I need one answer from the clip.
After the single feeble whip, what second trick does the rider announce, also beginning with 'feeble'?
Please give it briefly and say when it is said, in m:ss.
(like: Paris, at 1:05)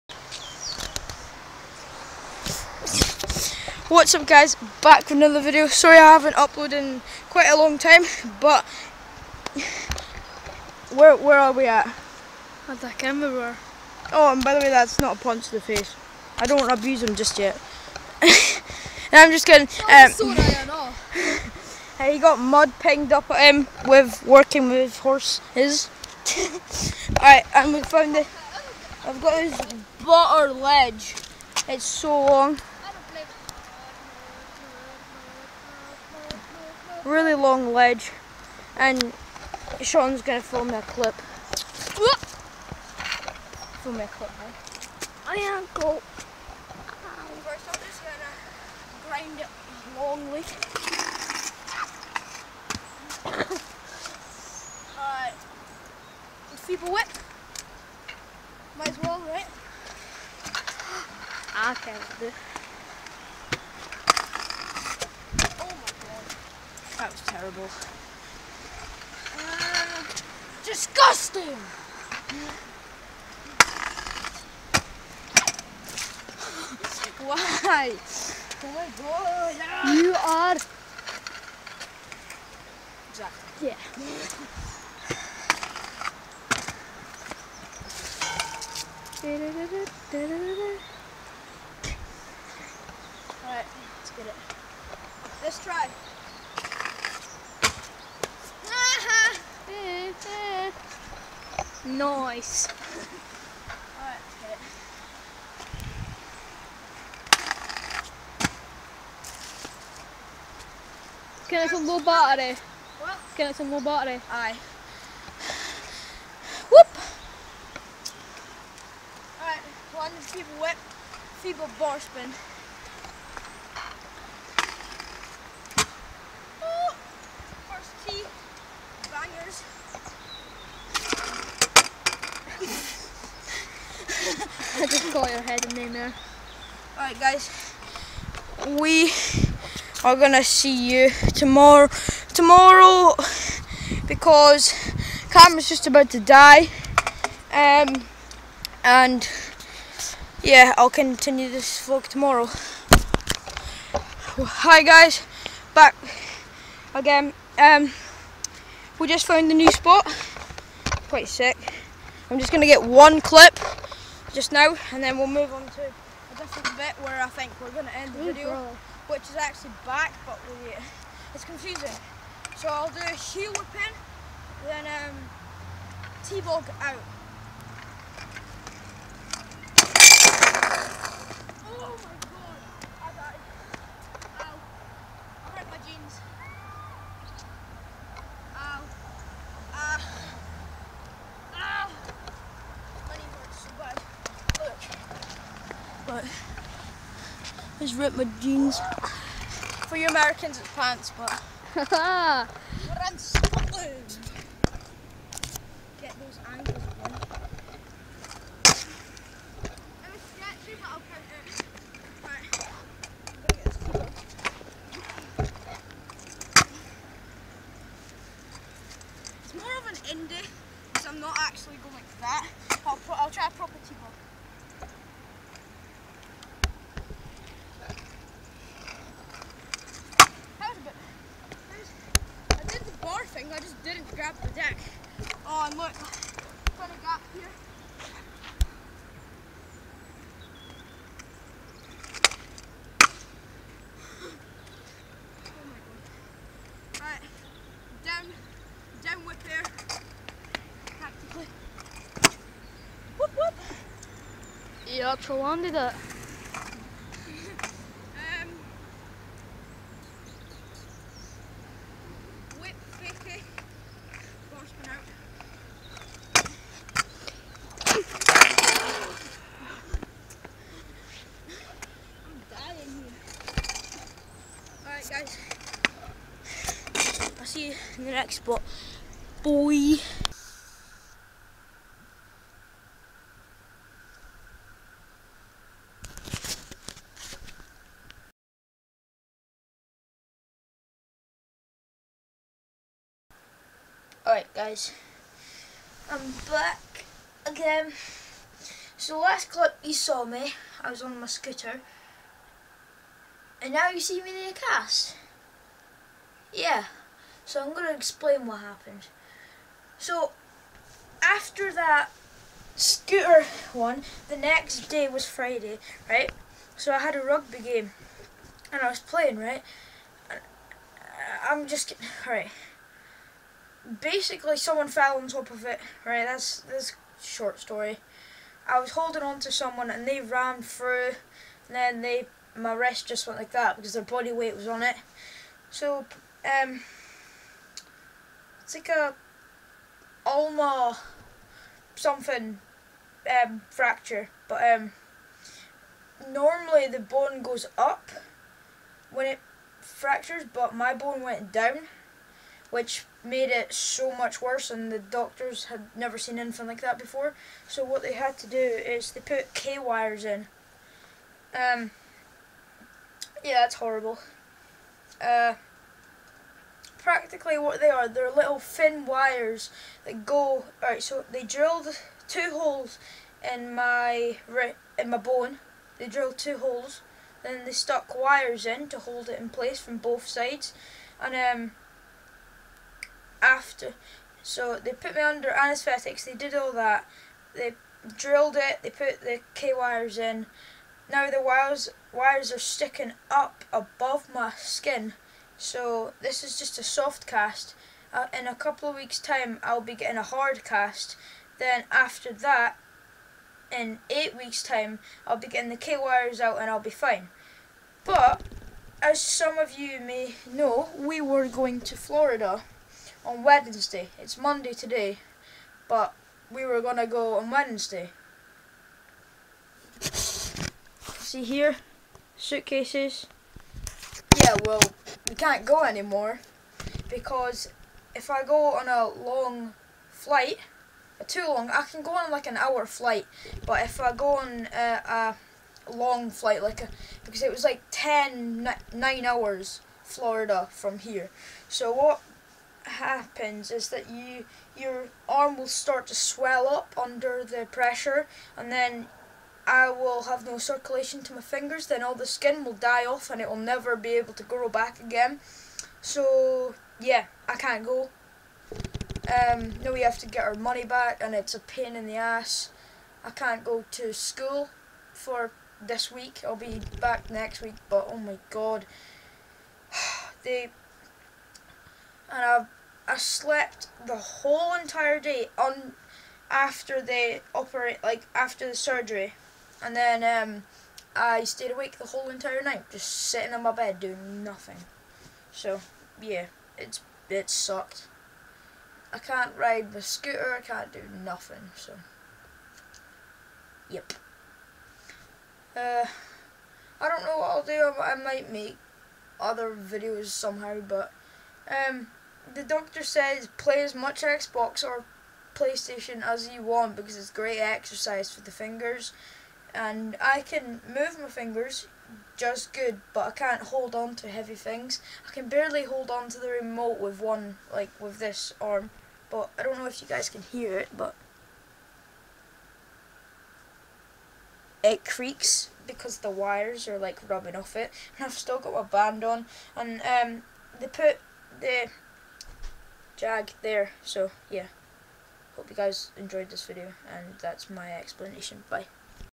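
Feeble bar spin, at 2:01.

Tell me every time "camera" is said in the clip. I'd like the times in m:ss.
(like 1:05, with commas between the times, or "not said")
0:12, 2:25.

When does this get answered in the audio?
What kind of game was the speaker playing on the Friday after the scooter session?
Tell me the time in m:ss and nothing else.
5:17.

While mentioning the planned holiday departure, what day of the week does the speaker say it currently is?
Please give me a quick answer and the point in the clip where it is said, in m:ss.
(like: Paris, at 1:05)
Monday, at 6:54.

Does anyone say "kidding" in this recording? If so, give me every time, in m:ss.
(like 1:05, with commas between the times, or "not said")
0:19, 5:21.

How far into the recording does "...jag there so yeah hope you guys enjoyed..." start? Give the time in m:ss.
8:53.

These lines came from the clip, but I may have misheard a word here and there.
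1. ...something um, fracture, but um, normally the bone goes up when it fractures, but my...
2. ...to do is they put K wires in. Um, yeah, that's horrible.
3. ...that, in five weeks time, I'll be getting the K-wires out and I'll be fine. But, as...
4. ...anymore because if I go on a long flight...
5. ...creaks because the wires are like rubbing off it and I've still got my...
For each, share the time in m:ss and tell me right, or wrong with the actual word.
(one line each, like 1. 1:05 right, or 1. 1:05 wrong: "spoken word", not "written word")
1. 5:41 right
2. 5:58 right
3. 6:42 wrong: "eight", not "five"
4. 7:05 right
5. 8:45 right.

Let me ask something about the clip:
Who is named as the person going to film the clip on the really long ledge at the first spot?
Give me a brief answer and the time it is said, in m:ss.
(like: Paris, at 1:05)
Sean, at 0:39.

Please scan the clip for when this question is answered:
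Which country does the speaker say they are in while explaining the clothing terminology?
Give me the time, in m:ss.
3:23.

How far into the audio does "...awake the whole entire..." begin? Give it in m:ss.
8:01.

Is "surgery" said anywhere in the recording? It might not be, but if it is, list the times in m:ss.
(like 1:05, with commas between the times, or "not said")
7:58.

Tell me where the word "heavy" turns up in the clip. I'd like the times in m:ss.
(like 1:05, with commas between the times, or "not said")
8:34.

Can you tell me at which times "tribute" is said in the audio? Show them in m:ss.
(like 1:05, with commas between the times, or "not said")
not said.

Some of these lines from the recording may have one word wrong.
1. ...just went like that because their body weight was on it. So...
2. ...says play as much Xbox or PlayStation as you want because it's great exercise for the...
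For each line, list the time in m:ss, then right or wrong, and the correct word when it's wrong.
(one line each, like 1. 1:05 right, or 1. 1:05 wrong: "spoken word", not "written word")
1. 5:33 right
2. 8:23 right.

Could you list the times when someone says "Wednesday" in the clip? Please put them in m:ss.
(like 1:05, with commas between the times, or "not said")
6:53, 6:57.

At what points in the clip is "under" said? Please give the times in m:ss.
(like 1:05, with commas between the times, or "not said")
6:25, 7:27.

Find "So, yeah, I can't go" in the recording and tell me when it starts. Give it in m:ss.
7:36.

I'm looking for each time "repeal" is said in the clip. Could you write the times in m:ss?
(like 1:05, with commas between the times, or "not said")
not said.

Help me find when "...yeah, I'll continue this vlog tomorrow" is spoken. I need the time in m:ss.
2:30.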